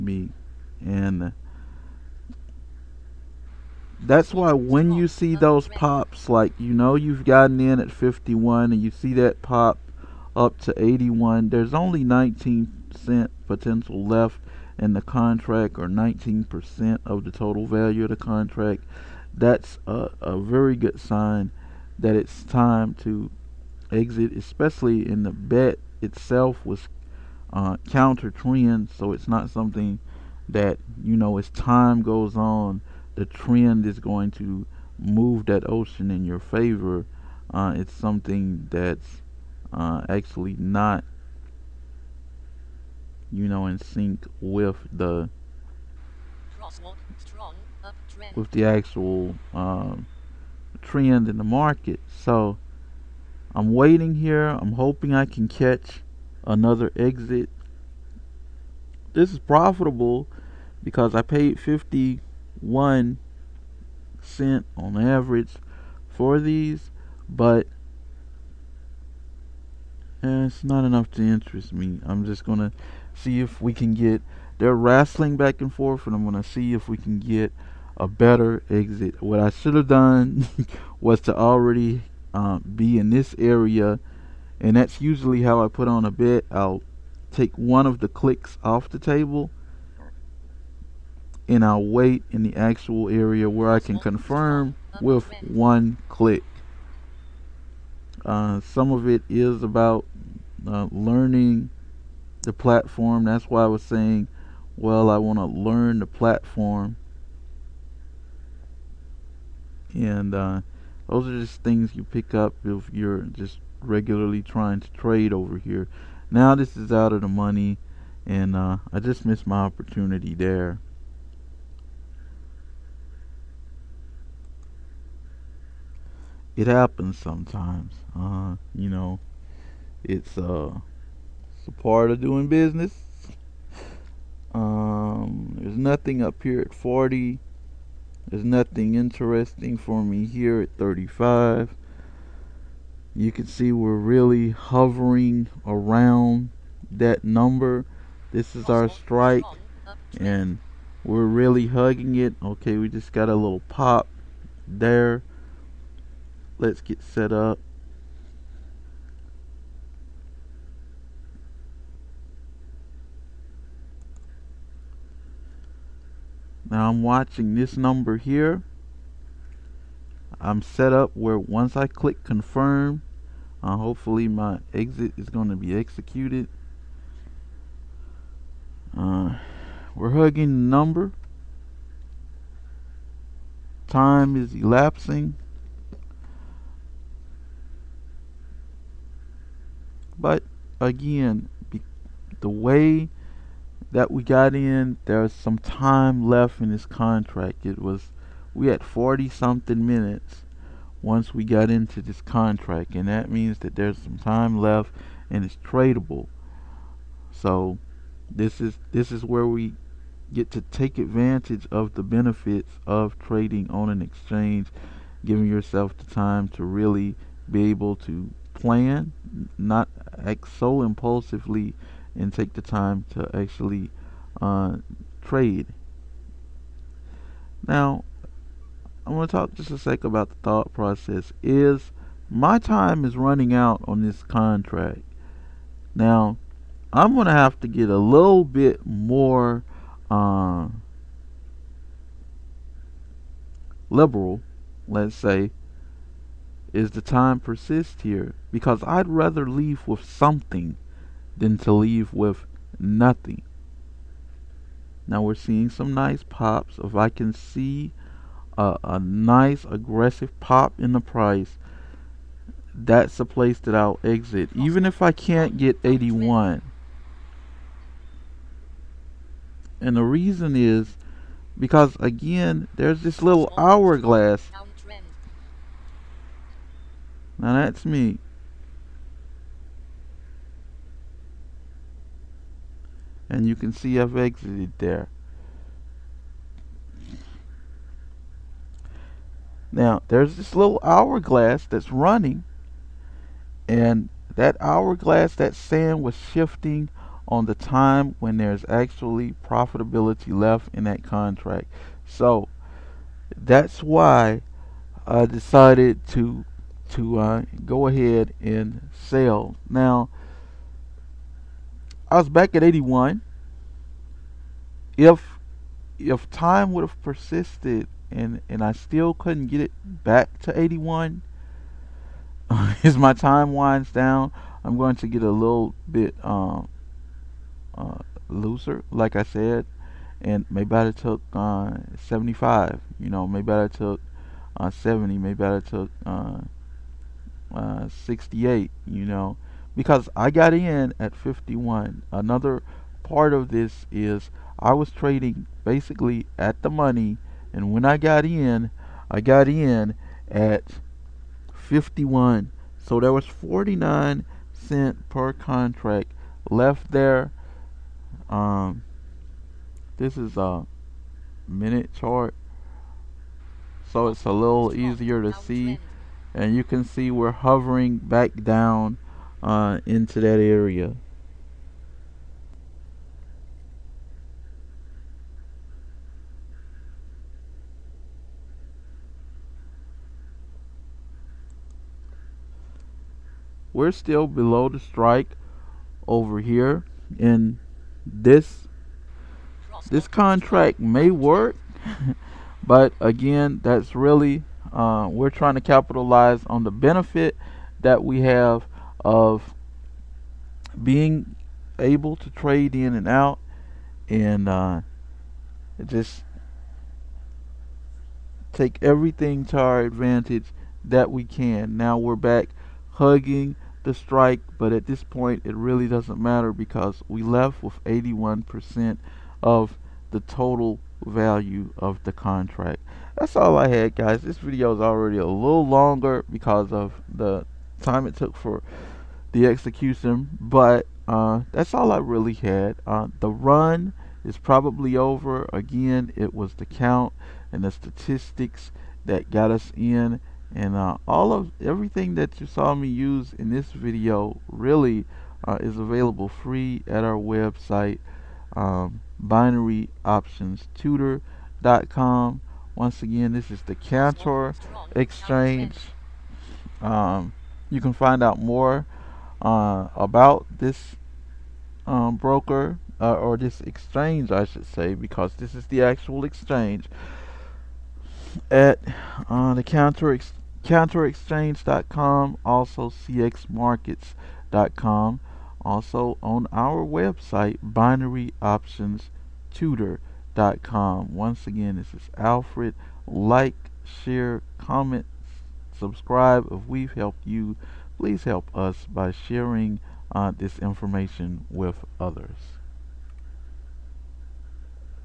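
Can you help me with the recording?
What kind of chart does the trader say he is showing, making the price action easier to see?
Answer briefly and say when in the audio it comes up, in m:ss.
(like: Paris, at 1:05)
minute chart, at 6:01.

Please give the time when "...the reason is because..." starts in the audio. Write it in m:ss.
4:29.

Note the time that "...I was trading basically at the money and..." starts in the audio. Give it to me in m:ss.
5:44.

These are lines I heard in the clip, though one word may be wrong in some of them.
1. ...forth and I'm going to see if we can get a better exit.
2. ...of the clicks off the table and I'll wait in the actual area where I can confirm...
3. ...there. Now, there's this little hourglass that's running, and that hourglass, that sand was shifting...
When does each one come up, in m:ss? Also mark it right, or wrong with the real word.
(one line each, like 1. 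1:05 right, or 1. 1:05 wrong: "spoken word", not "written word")
1. 1:15 right
2. 1:27 right
3. 4:44 right.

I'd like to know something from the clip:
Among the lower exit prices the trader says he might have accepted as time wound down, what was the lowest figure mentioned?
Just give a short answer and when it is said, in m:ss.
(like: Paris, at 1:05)
68, at 5:38.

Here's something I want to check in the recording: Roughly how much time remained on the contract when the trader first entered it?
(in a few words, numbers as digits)
40 something minutes.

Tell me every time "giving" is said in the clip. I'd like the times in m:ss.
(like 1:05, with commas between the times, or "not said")
3:35.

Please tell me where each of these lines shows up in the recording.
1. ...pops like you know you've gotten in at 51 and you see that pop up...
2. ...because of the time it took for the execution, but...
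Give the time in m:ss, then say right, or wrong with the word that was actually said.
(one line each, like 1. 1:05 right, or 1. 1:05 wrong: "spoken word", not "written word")
1. 0:05 right
2. 7:06 right.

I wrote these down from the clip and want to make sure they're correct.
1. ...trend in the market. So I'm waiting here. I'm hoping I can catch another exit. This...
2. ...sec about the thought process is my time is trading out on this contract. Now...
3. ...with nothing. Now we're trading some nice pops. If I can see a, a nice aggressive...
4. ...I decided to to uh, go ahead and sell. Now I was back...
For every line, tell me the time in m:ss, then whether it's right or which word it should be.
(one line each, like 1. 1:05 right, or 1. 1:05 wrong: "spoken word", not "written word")
1. 0:50 right
2. 3:49 wrong: "running", not "trading"
3. 4:12 wrong: "seeing", not "trading"
4. 5:05 right.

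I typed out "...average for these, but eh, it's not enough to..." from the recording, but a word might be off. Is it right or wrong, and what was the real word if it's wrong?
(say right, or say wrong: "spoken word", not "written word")
right.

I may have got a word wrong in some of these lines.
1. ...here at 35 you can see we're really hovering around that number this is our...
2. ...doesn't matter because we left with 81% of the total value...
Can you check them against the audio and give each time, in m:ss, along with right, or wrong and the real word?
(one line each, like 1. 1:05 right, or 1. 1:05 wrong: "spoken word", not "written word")
1. 2:20 right
2. 6:55 right.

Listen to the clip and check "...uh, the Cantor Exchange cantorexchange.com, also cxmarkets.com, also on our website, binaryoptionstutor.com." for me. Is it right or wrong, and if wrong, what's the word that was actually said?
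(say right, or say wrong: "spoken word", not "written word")
right.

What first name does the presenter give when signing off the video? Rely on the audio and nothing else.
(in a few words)
Alfred.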